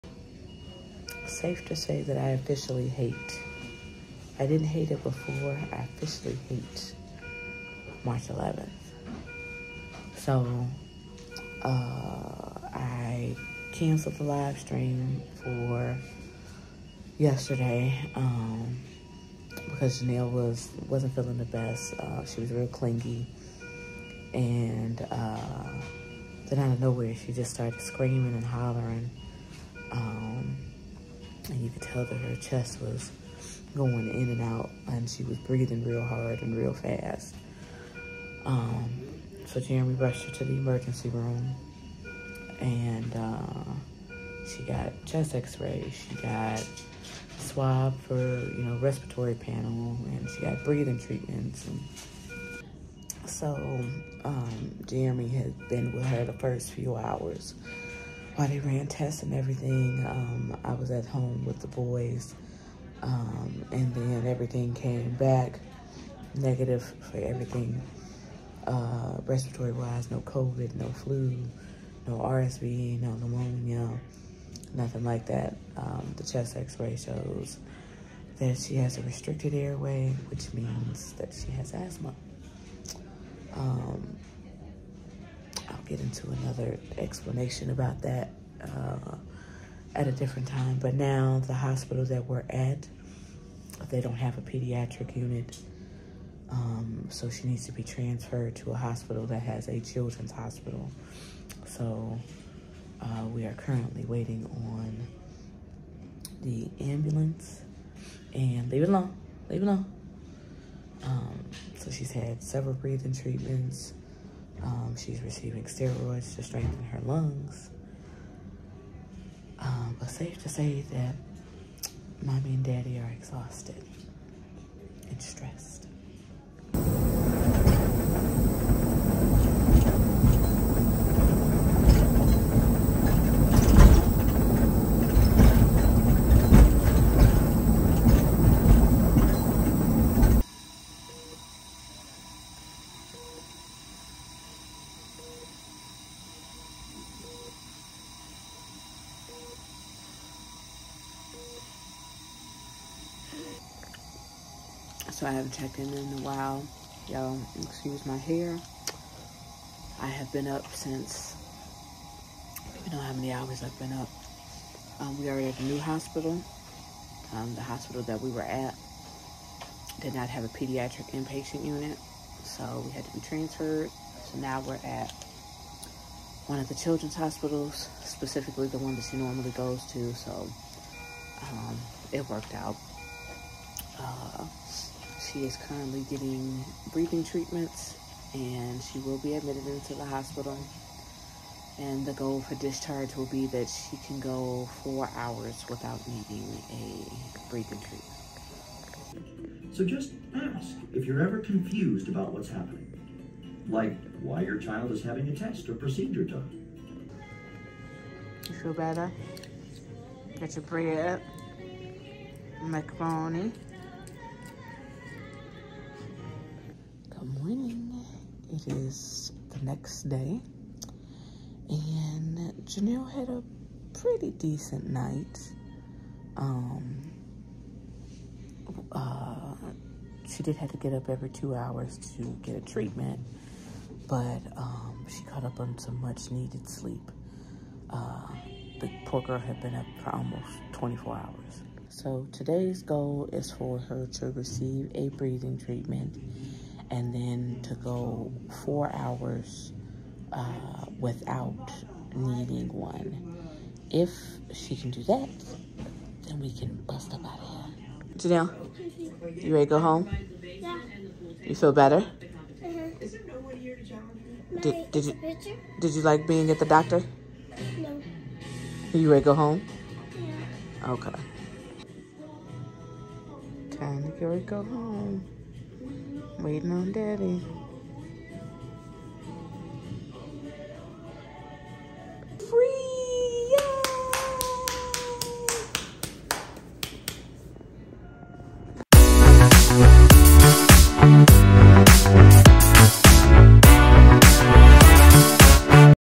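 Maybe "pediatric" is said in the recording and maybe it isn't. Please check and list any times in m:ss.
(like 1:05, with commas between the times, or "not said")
1:34, 2:50.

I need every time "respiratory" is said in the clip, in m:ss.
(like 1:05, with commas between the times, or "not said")
0:48, 1:09.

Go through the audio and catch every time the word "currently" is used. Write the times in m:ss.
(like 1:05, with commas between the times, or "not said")
1:43, 3:05.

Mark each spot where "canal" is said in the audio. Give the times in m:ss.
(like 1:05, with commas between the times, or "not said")
not said.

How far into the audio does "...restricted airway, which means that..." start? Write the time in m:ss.
1:19.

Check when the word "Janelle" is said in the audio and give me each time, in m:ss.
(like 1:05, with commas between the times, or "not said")
0:20, 3:42, 4:18.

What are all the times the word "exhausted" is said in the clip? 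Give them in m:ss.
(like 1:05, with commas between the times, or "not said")
2:03.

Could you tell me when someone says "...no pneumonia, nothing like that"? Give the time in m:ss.
1:13.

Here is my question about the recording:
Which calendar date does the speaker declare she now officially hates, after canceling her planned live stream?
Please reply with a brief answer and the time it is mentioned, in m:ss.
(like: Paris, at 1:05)
March 11th, at 0:08.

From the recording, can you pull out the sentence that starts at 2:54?
So now we're at one of the children's hospitals, specifically the one that she normally goes to.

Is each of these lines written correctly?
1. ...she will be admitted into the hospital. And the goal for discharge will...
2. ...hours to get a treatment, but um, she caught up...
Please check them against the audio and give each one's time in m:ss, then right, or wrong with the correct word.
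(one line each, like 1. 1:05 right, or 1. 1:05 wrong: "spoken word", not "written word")
1. 3:08 right
2. 3:51 right.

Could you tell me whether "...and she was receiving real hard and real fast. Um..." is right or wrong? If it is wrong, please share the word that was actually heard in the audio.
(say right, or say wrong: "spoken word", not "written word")
wrong: "breathing", not "receiving".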